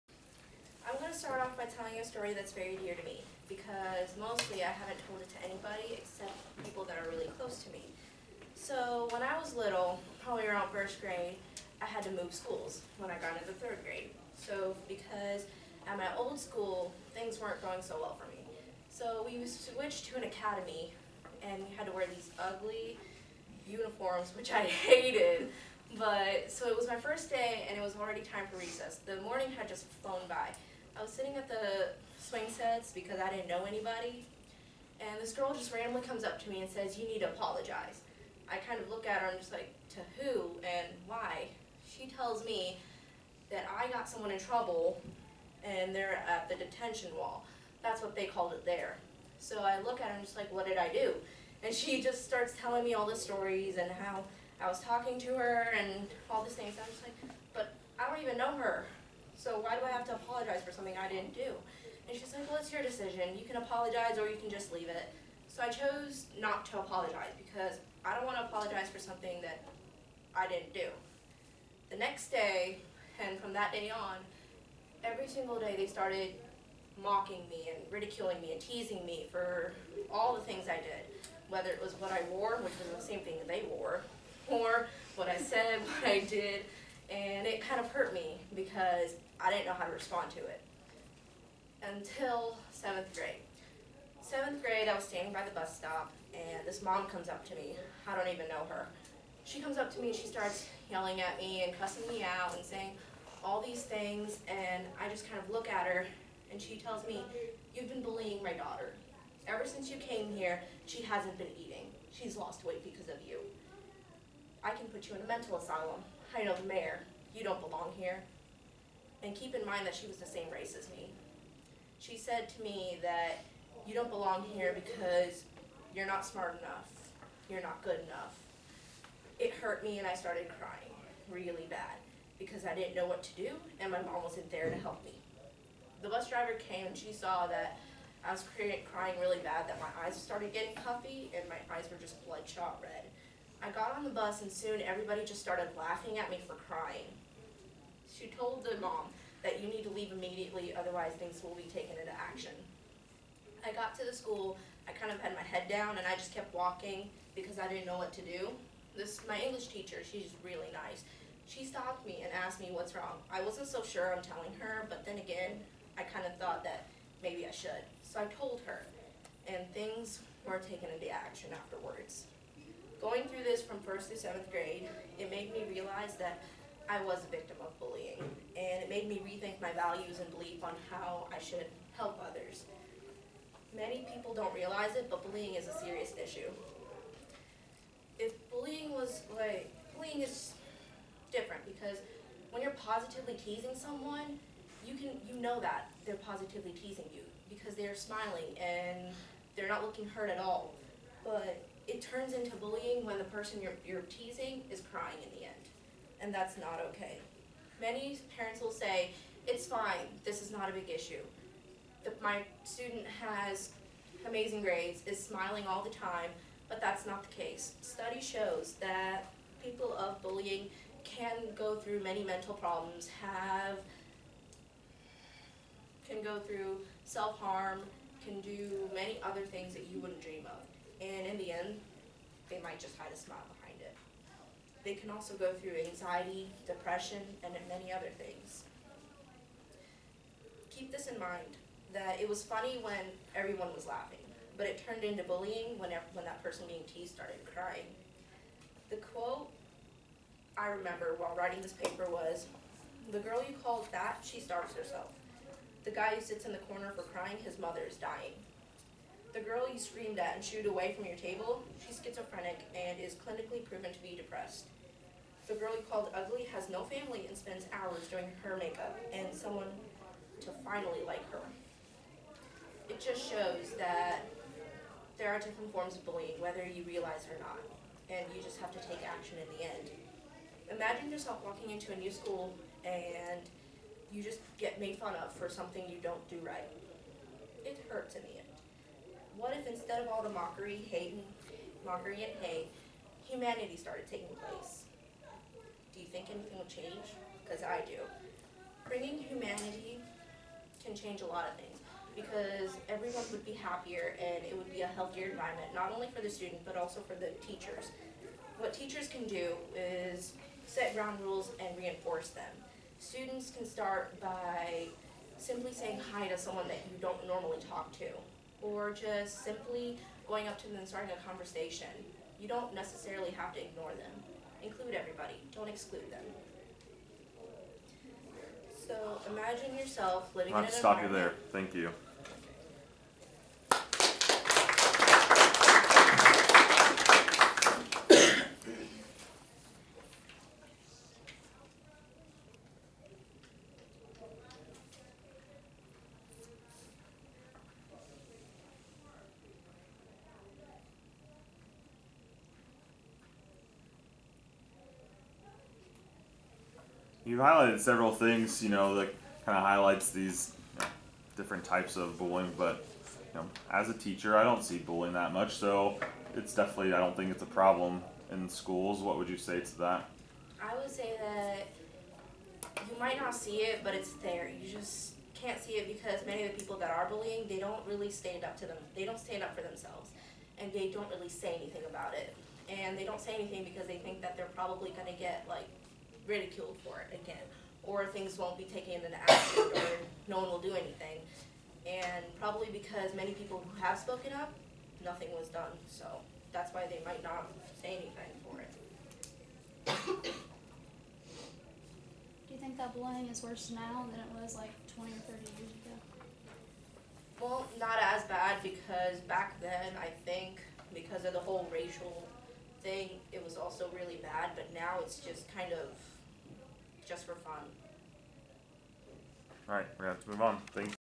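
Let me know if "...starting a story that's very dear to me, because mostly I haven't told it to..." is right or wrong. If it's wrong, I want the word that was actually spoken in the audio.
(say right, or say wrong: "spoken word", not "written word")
wrong: "telling", not "starting".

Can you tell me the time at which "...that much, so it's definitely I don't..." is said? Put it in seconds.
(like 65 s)
365 s.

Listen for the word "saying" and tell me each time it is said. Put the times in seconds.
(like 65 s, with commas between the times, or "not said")
102 s, 315 s.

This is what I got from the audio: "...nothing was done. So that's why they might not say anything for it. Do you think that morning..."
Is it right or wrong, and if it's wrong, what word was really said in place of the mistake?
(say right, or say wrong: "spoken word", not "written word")
wrong: "bullying", not "morning".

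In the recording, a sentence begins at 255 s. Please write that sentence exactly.
The guy who sits in the corner for crying, his mother is dying.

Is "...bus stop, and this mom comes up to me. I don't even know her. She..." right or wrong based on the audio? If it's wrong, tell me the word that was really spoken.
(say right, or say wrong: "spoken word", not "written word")
right.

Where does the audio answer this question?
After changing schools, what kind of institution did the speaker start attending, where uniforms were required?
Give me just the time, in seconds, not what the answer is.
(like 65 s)
20 s.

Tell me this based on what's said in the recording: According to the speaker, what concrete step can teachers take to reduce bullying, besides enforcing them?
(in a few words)
Set ground rules.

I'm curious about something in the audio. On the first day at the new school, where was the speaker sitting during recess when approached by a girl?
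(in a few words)
The swing sets.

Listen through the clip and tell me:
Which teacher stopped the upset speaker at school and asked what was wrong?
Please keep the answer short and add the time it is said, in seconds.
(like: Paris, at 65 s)
English teacher, at 159 s.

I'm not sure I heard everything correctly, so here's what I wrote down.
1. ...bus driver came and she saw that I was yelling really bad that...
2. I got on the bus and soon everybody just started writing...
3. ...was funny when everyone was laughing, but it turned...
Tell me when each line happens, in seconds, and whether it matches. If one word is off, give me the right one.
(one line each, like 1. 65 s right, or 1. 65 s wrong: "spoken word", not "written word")
1. 136 s wrong: "crying", not "yelling"
2. 143 s wrong: "laughing", not "writing"
3. 242 s right.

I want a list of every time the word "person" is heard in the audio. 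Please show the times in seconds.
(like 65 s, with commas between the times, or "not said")
203 s, 246 s.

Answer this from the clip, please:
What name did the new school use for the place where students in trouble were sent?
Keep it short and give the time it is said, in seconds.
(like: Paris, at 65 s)
The detention wall, at 46 s.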